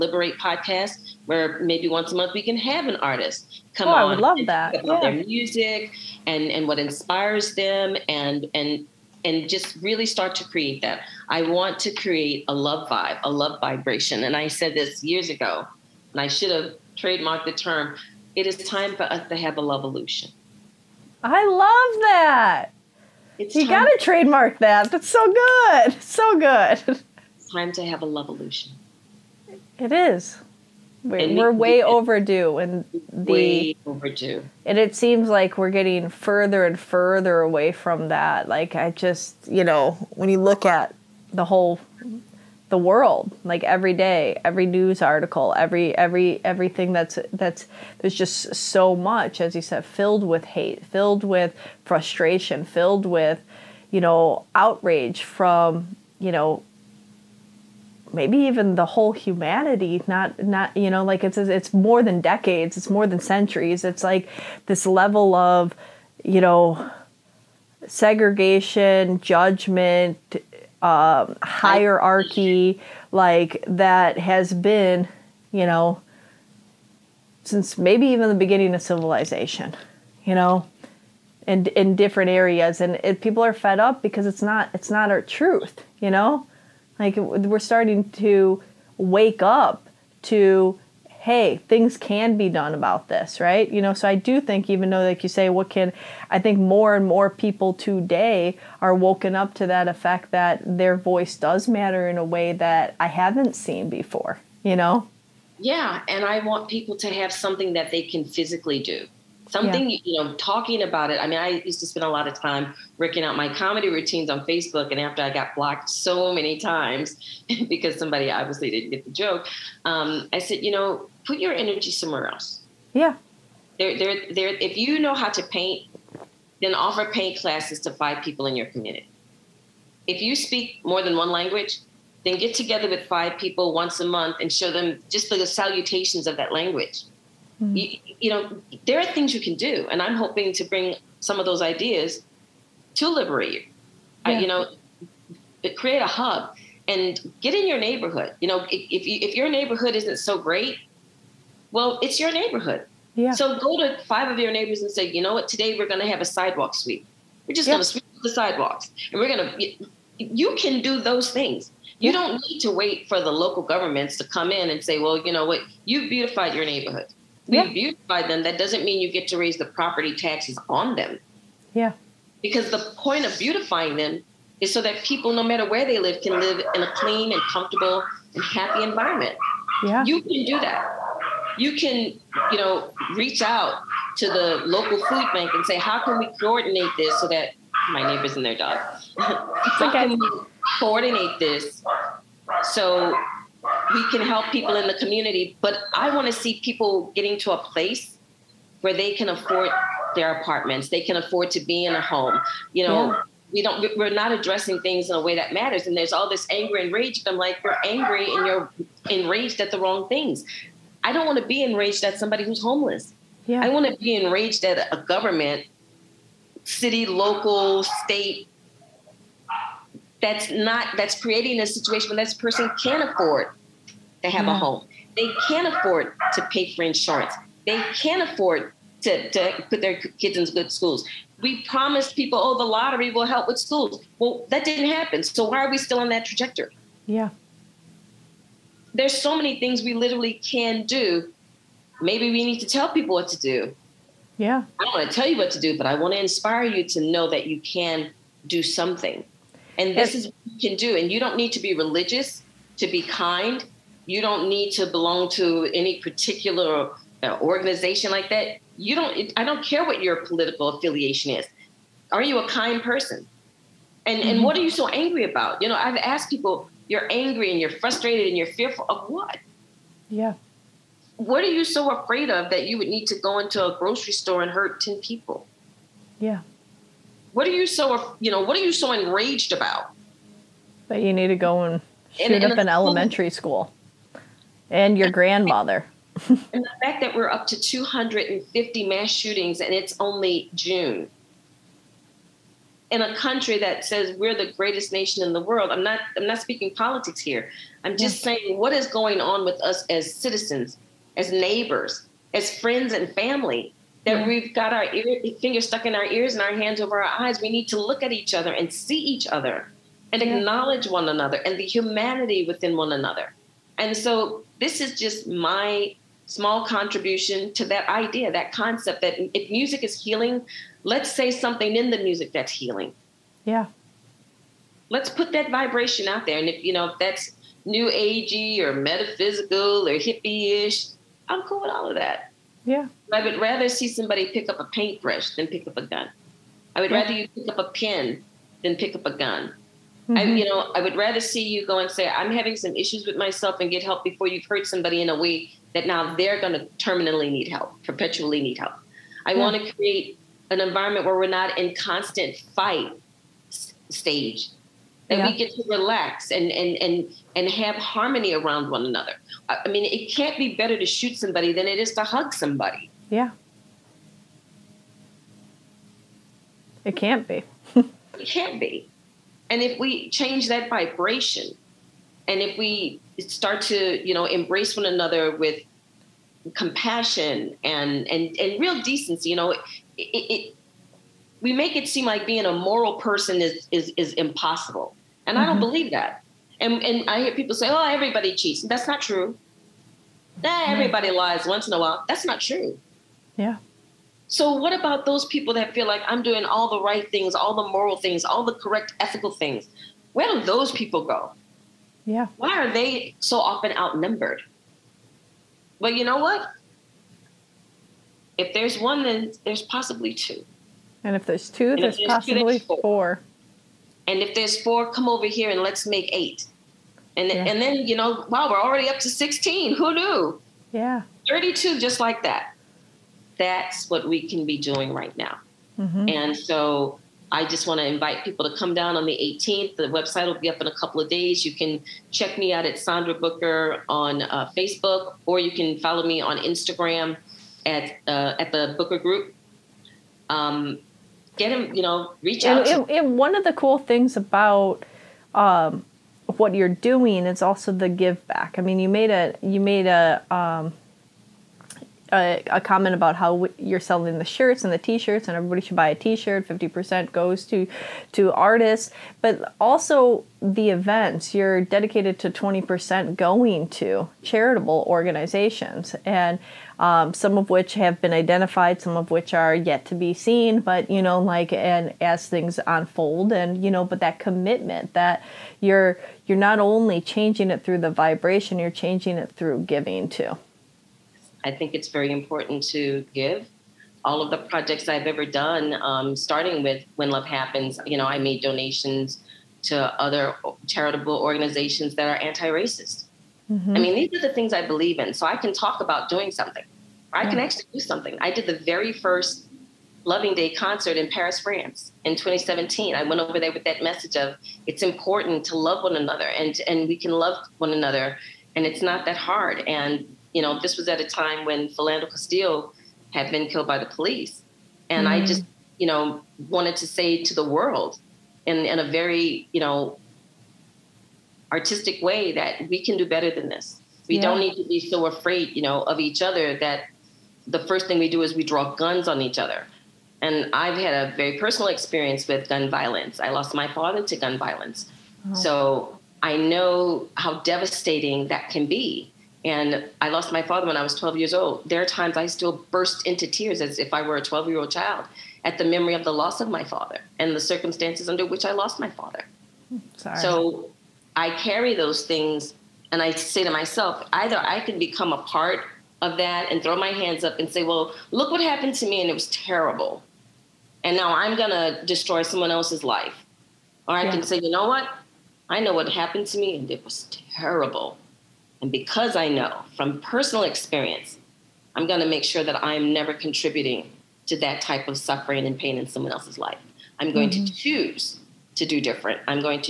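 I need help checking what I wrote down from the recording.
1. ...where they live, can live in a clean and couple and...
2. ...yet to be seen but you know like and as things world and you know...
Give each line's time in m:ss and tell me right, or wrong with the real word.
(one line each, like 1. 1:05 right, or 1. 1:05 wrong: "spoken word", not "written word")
1. 2:55 wrong: "comfortable", not "couple"
2. 7:49 wrong: "unfold", not "world".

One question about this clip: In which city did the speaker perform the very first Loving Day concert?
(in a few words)
Paris.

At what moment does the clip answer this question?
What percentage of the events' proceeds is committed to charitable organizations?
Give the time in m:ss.
7:42.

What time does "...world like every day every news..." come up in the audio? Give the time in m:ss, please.
0:42.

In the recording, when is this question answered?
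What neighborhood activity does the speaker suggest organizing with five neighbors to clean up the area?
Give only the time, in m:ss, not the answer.
2:36.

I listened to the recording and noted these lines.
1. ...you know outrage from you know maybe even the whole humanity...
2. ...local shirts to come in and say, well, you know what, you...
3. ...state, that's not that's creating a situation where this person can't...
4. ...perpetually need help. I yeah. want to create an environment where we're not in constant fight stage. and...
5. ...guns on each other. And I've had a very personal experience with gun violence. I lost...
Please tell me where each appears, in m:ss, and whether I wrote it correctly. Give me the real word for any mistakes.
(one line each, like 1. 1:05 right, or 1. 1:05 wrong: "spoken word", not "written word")
1. 0:53 right
2. 2:43 wrong: "governments", not "shirts"
3. 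3:37 right
4. 5:47 right
5. 8:48 right.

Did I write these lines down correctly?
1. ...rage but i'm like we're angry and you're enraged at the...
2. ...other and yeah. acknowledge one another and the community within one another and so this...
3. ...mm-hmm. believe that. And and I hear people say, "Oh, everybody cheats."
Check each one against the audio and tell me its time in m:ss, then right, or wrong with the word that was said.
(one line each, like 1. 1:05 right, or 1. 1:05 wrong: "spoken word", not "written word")
1. 3:26 right
2. 5:09 wrong: "humanity", not "community"
3. 6:25 right.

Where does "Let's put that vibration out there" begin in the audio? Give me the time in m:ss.
5:24.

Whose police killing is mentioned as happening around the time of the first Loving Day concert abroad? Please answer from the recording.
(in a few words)
Philando Castile.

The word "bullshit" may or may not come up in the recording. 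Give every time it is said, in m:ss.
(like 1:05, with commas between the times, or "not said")
not said.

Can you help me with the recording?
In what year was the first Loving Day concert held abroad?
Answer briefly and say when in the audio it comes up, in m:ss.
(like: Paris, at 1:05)
2017, at 8:22.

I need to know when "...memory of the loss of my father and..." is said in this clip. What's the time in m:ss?
9:05.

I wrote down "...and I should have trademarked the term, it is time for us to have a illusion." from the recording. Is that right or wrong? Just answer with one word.
right.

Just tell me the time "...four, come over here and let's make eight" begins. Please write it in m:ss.
6:54.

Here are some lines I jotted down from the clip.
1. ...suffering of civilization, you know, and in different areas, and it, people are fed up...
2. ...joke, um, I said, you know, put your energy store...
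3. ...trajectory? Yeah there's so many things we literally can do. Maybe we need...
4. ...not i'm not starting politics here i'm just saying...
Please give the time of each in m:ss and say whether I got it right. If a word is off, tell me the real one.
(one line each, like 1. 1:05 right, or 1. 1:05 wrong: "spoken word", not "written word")
1. 1:18 wrong: "beginning", not "suffering"
2. 1:59 wrong: "somewhere", not "store"
3. 3:56 right
4. 4:55 wrong: "speaking", not "starting".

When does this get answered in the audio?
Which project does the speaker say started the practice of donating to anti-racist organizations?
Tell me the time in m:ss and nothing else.
8:06.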